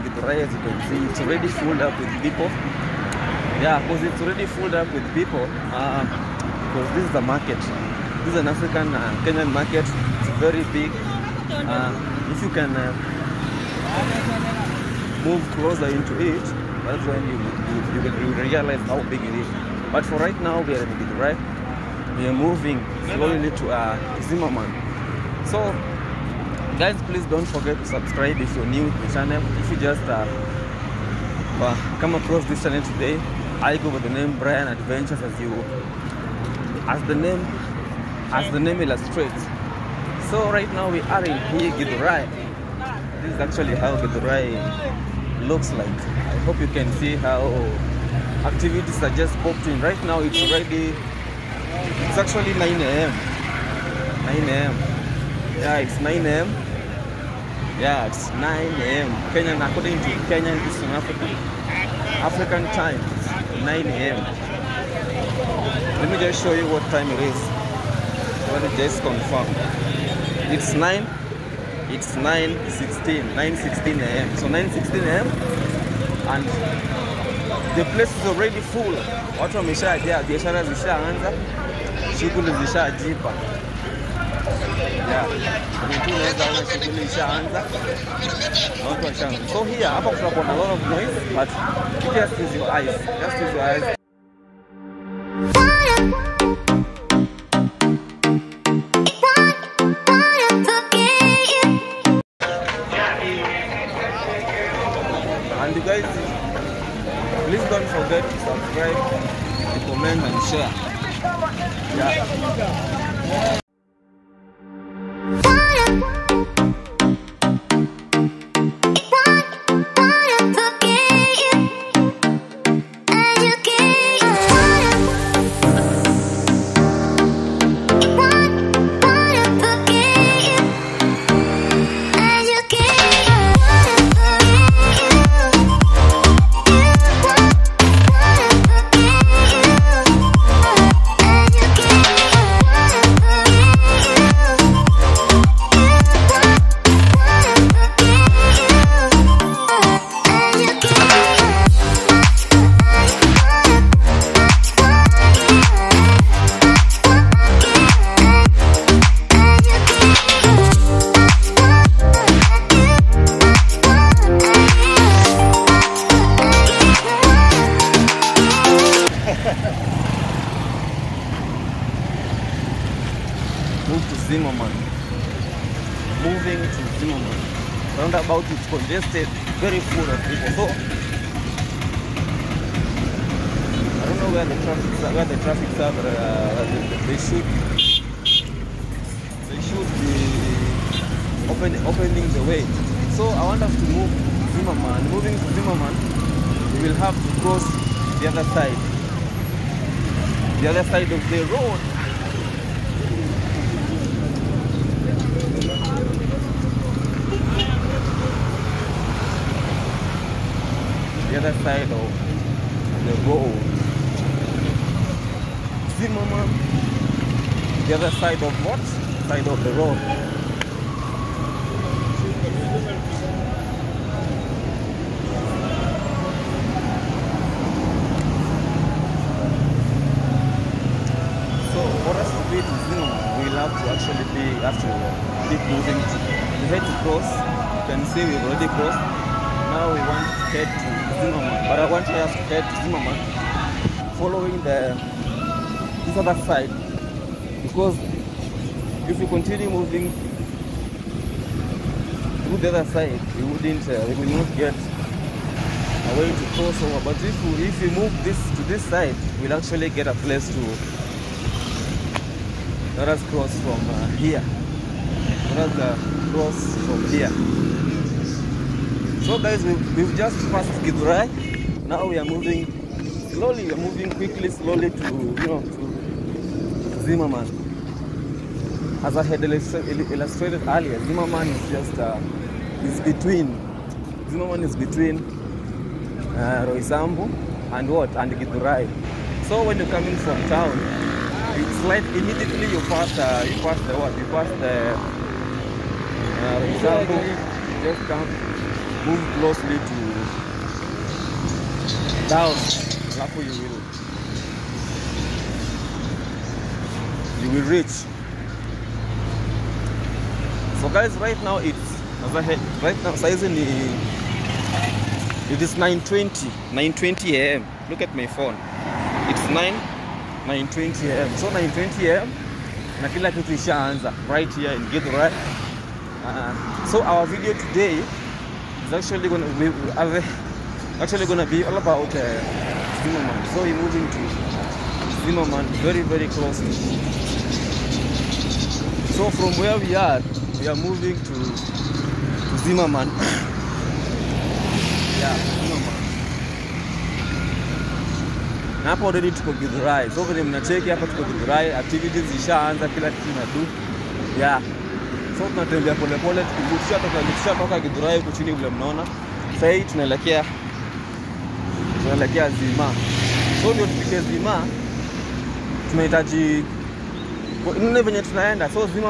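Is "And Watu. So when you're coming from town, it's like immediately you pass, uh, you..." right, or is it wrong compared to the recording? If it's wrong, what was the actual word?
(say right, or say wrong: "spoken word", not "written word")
wrong: "Githurai", not "Watu".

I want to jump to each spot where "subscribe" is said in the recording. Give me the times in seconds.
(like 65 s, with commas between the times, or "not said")
27 s, 108 s.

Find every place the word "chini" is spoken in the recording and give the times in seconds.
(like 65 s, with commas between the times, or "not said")
358 s.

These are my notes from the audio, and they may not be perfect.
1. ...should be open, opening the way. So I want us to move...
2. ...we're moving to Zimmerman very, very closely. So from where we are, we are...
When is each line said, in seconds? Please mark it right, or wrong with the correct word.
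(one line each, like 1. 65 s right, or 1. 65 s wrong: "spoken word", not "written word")
1. 189 s right
2. 333 s right.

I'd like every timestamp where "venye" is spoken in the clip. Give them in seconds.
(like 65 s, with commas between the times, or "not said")
350 s, 368 s.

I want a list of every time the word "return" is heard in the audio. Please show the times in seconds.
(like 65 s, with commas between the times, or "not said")
not said.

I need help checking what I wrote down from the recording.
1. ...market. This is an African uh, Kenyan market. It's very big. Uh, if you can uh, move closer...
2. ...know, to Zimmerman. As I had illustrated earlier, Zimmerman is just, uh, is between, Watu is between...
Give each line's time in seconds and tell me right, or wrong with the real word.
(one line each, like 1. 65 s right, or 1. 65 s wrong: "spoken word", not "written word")
1. 7 s right
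2. 275 s wrong: "Zimmerman", not "Watu".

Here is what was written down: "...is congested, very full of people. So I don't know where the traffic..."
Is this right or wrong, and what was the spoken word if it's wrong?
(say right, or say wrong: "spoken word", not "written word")
right.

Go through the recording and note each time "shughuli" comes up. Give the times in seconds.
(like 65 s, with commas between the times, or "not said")
82 s.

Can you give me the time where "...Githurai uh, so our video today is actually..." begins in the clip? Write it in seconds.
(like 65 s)
324 s.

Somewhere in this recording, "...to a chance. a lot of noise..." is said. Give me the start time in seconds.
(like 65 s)
86 s.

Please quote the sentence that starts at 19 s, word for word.
But for right now, we are in Githurai.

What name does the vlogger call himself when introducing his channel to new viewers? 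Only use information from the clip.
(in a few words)
Brian Adventures.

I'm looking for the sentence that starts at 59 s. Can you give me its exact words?
Kenyan, according to Kenyan, this is African, African time, 9 a.m.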